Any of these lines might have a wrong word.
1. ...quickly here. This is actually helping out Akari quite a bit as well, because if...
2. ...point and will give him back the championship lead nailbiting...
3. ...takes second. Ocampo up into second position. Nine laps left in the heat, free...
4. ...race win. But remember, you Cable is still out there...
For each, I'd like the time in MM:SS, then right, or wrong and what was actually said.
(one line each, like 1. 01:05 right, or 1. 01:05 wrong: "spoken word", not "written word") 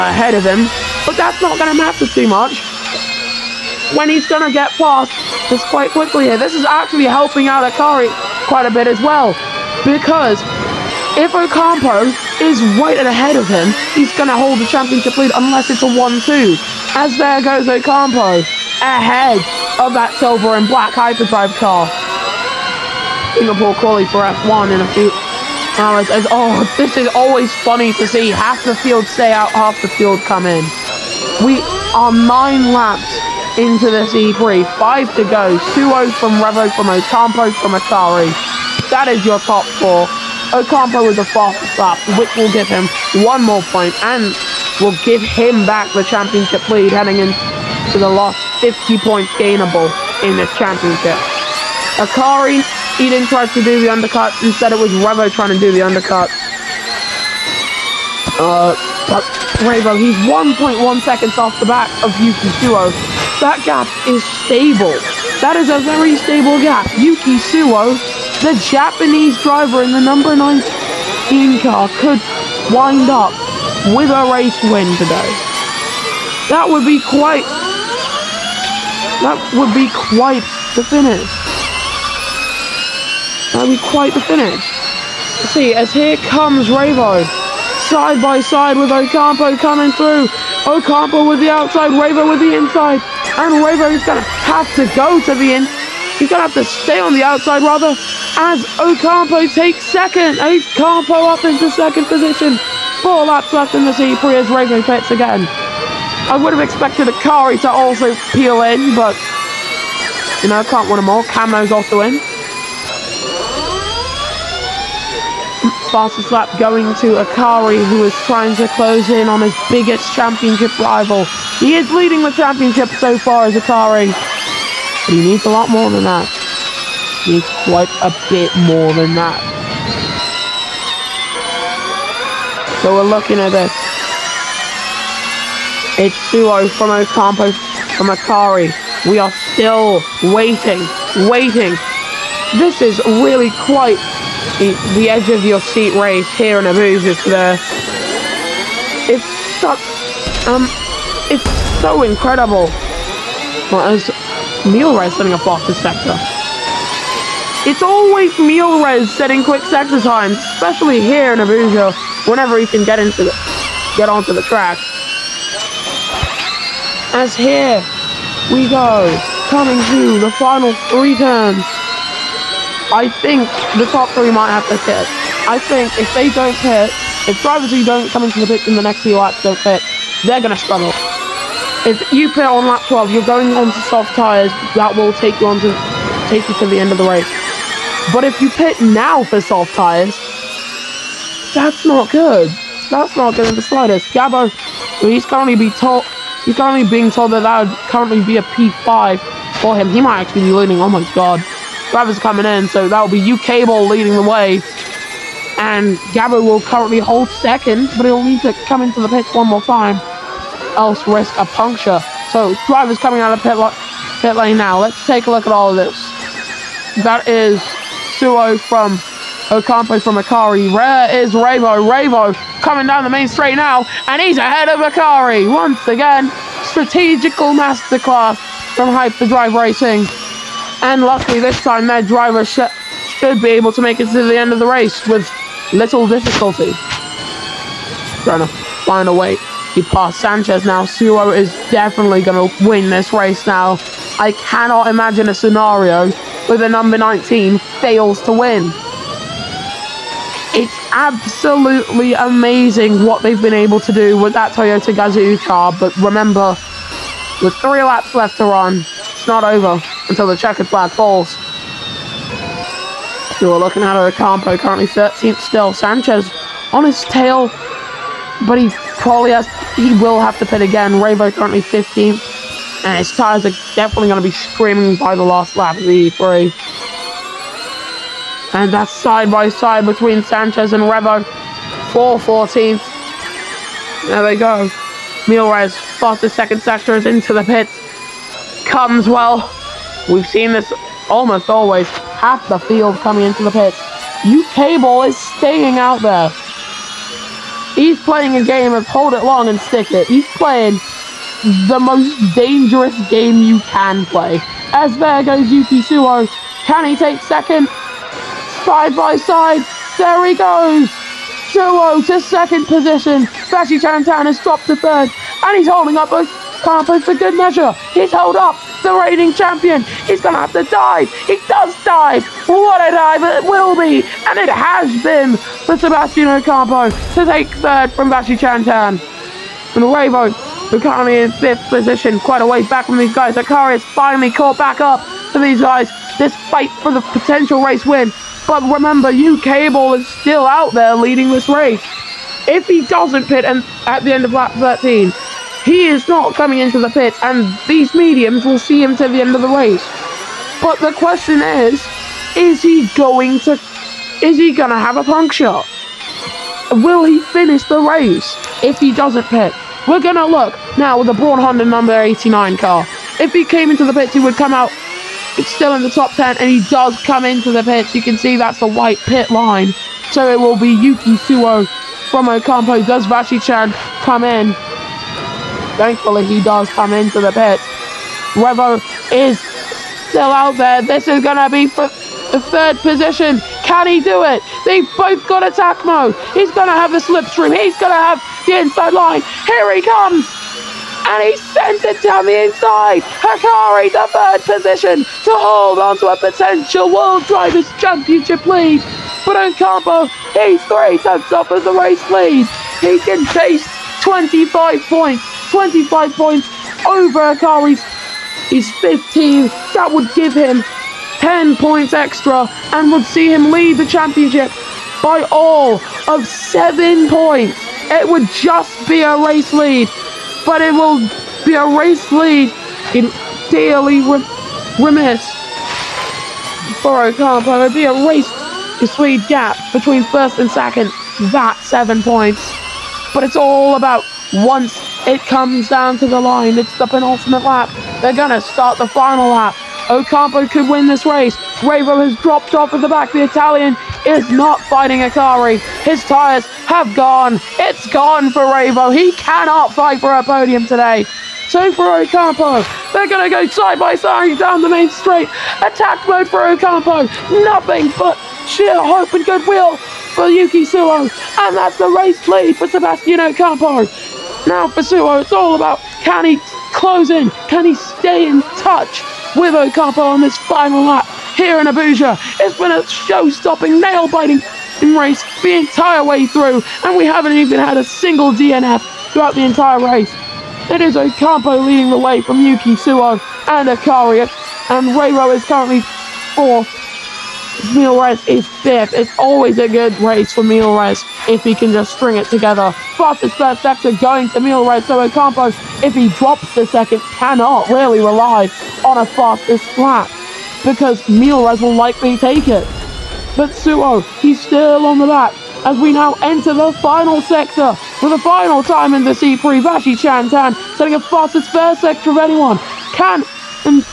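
1. 00:05 right
2. 00:43 wrong: "heading", not "nailbiting"
3. 01:39 wrong: "Four", not "Nine"
4. 05:37 right.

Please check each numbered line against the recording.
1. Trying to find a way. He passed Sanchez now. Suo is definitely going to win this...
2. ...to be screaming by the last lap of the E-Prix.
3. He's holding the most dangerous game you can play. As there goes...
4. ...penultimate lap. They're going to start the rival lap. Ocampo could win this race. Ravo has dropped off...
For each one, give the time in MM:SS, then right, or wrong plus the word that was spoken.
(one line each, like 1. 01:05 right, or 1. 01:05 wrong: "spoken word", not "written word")
1. 03:58 right
2. 04:34 right
3. 05:00 wrong: "playing", not "holding"
4. 07:16 wrong: "final", not "rival".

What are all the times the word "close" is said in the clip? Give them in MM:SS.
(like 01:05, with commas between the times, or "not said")
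01:58, 07:46.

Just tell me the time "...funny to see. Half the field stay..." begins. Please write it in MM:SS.
00:27.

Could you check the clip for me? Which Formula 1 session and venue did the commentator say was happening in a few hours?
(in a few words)
Singapore quali.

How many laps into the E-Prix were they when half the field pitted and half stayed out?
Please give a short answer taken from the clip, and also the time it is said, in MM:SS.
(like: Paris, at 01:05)
9, at 00:32.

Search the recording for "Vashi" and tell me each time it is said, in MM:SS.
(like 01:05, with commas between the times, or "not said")
06:13, 08:29.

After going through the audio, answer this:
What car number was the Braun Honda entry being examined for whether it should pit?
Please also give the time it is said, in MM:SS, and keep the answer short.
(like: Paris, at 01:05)
89, at 06:01.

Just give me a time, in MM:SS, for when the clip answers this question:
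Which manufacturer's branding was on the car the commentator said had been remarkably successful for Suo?
04:14.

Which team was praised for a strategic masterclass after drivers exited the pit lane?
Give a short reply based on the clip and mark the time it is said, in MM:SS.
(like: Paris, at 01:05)
Hyperdrive Racing, at 03:48.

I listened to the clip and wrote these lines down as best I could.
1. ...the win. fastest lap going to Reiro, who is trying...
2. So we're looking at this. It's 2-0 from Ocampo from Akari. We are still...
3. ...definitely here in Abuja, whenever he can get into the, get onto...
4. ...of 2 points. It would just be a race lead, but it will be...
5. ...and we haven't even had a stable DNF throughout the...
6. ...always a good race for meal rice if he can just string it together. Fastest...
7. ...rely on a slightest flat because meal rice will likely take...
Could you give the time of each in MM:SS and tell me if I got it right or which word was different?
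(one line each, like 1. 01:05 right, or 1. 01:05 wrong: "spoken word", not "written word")
1. 01:51 wrong: "Akari", not "Reiro"
2. 02:12 right
3. 02:40 wrong: "especially", not "definitely"
4. 06:56 wrong: "7", not "2"
5. 07:56 wrong: "single", not "stable"
6. 08:09 right
7. 08:17 wrong: "fastest", not "slightest".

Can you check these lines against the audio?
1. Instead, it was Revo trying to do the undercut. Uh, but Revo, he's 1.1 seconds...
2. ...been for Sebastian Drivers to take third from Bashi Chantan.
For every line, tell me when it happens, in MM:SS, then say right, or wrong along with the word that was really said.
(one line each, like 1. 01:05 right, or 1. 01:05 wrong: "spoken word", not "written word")
1. 00:54 right
2. 05:25 wrong: "Ocampo", not "Drivers".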